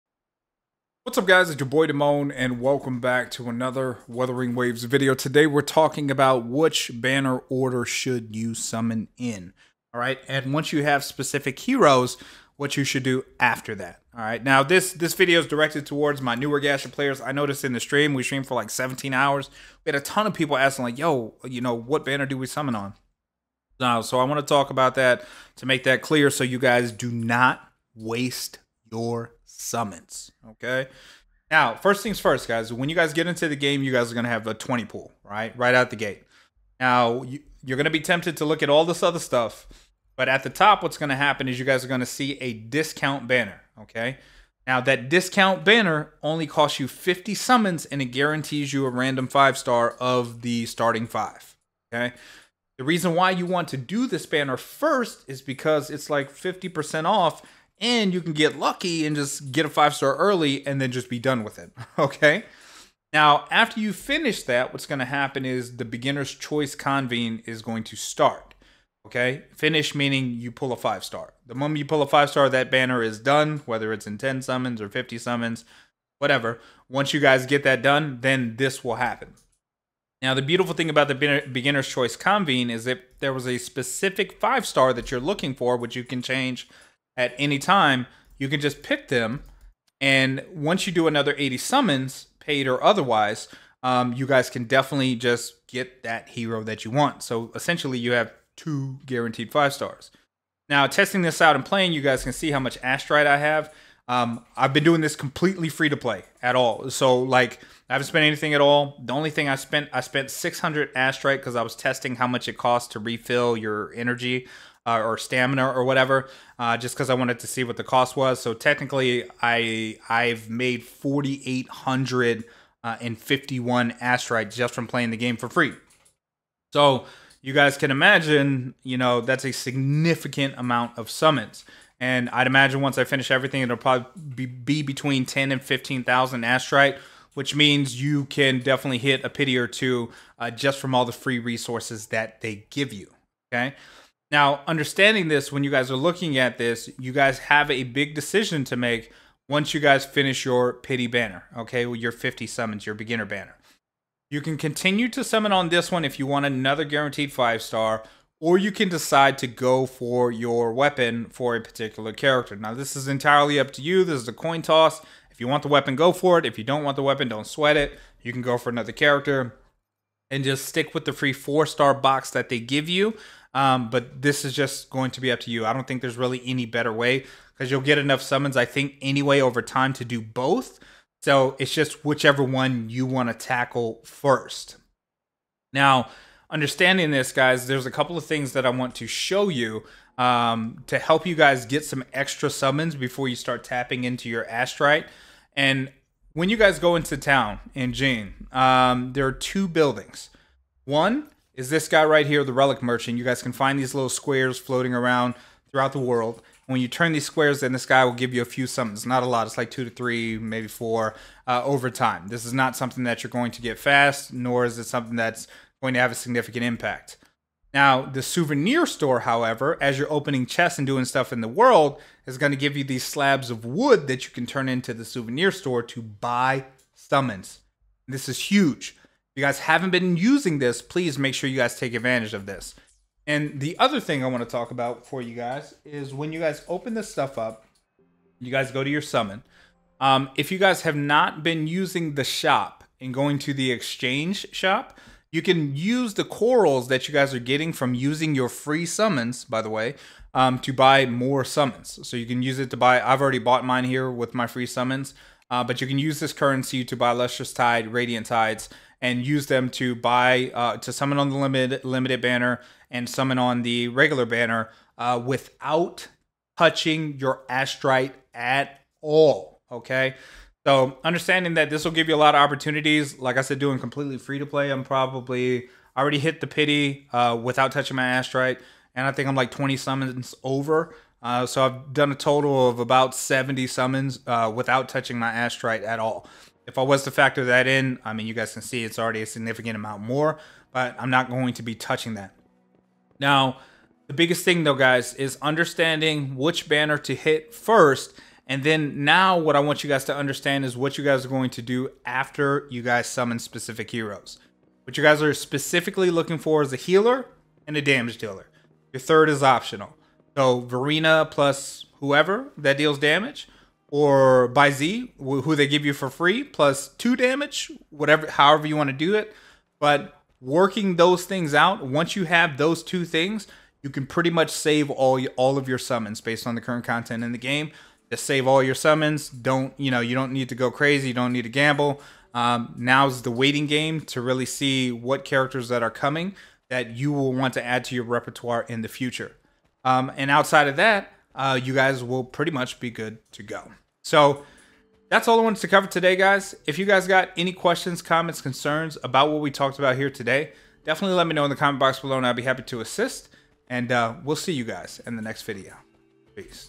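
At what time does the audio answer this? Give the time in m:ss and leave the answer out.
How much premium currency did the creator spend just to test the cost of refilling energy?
1:50.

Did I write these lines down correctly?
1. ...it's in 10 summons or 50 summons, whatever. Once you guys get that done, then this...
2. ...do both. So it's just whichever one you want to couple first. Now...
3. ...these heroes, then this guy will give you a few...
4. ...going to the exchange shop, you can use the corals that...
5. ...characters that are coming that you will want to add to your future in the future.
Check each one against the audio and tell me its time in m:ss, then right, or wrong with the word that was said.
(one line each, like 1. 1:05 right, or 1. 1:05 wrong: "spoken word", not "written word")
1. 1:13 right
2. 3:00 wrong: "tackle", not "couple"
3. 3:27 wrong: "squares", not "heroes"
4. 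4:03 right
5. 5:35 wrong: "repertoire", not "future".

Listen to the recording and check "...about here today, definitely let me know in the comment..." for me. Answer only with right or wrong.
right.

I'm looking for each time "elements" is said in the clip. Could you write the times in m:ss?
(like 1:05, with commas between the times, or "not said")
not said.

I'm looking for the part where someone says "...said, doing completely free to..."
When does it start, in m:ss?
4:33.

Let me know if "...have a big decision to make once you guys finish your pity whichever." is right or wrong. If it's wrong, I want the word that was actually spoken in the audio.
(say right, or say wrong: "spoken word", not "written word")
wrong: "banner", not "whichever".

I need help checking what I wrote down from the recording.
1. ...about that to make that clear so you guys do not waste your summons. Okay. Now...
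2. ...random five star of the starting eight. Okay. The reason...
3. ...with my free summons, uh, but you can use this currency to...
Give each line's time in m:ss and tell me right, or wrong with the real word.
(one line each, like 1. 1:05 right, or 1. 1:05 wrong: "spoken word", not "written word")
1. 0:24 right
2. 0:48 wrong: "five", not "eight"
3. 4:14 right.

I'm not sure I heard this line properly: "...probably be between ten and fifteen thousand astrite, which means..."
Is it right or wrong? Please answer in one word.
right.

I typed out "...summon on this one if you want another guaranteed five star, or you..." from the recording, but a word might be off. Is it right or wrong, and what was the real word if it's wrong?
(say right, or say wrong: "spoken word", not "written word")
right.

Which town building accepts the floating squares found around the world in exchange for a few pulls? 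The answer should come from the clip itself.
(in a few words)
Relic Merchant.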